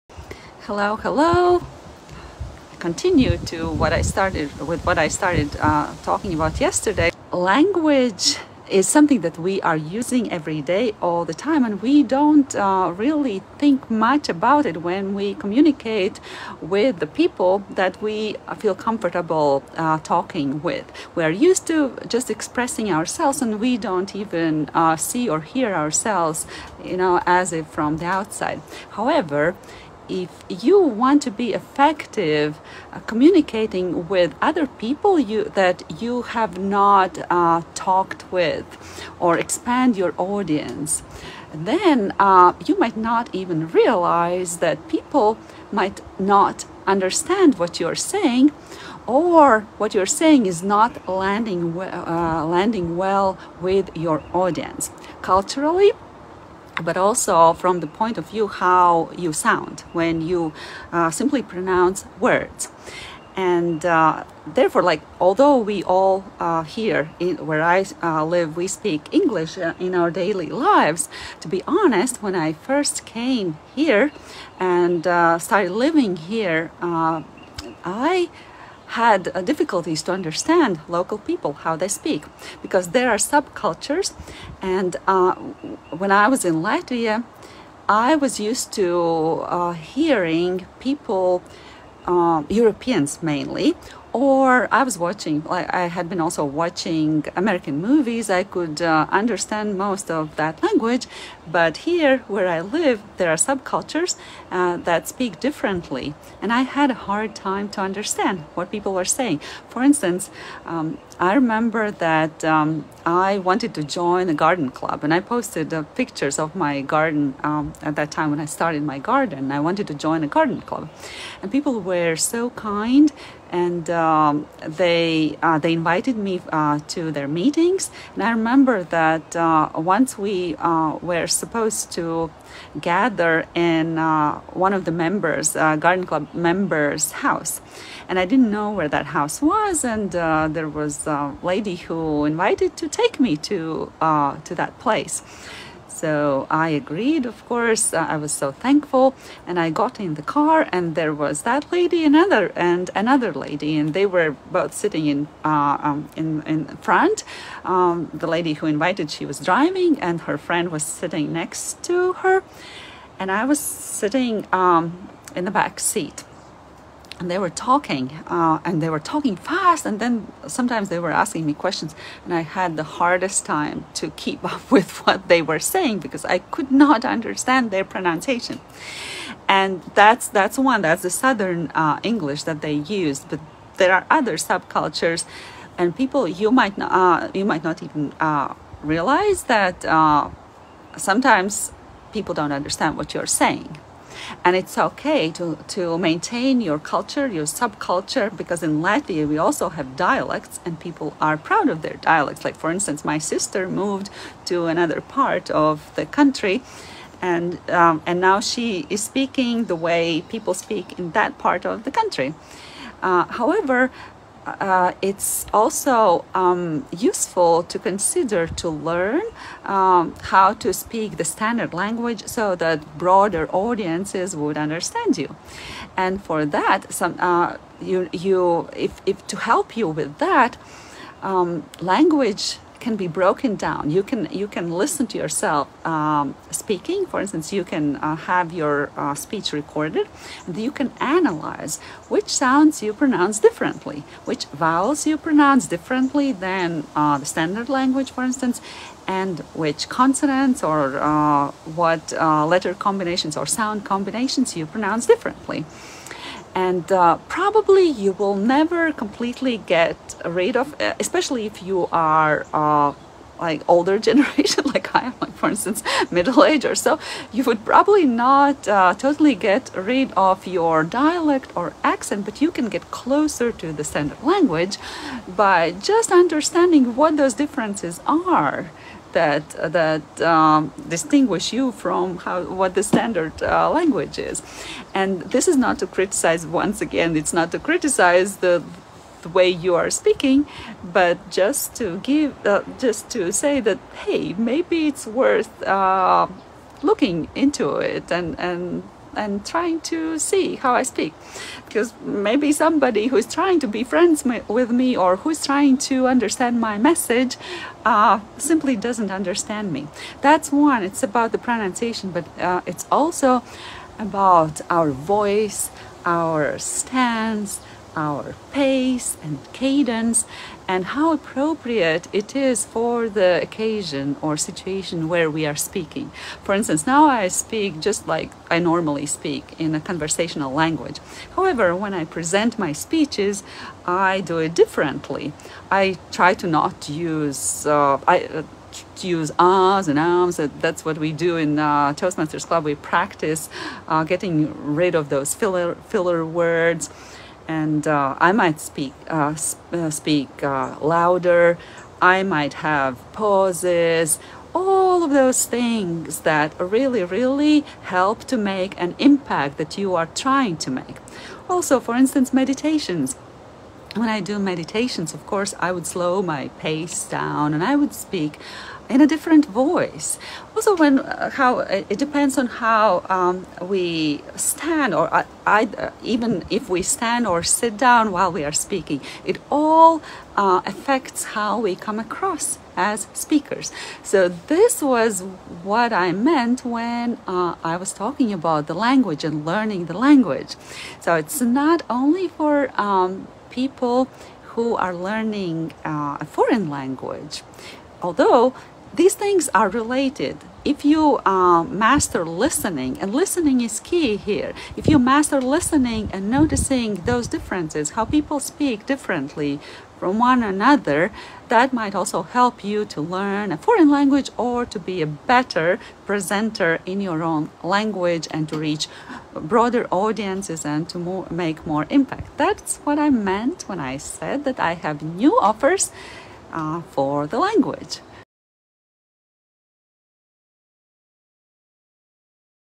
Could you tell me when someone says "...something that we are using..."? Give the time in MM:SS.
00:08.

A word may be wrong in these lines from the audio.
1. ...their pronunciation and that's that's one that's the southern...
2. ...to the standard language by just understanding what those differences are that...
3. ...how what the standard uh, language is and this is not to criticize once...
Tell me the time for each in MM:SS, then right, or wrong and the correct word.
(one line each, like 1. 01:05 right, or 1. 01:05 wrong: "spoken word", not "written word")
1. 02:57 right
2. 04:33 right
3. 04:42 right.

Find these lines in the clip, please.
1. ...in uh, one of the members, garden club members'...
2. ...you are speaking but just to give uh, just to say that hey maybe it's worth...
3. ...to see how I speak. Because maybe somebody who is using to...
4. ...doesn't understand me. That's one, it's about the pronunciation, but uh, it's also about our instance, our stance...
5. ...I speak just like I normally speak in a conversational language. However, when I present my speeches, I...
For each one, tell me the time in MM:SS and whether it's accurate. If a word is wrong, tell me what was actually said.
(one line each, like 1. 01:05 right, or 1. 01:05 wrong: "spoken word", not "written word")
1. 02:13 right
2. 04:49 right
3. 04:59 wrong: "trying", not "using"
4. 05:08 wrong: "voice", not "instance"
5. 05:27 right.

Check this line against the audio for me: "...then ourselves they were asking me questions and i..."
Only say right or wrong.
wrong.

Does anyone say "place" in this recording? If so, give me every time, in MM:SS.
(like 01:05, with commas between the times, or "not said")
02:24.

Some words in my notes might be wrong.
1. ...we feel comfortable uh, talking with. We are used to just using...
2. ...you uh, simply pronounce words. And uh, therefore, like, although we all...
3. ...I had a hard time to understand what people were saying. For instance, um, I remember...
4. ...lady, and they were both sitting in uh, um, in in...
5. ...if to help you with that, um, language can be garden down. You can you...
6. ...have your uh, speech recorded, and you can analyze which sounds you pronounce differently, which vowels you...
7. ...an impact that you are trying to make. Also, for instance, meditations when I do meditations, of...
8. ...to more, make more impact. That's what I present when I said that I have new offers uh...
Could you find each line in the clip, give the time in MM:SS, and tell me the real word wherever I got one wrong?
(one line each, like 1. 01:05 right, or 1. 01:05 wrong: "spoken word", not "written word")
1. 00:17 wrong: "expressing", not "using"
2. 01:00 right
3. 01:46 right
4. 02:33 right
5. 03:49 wrong: "broken", not "garden"
6. 03:58 right
7. 05:58 right
8. 07:00 wrong: "meant", not "present".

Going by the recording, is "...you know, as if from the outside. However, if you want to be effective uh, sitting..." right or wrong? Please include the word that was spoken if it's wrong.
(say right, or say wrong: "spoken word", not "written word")
wrong: "communicating", not "sitting".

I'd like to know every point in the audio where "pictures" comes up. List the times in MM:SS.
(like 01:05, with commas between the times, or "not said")
01:55.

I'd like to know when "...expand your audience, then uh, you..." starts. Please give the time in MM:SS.
00:39.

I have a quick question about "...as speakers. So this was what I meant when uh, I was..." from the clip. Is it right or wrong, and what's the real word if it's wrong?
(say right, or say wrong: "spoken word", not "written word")
right.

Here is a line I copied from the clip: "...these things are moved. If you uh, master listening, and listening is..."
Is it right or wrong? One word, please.
wrong.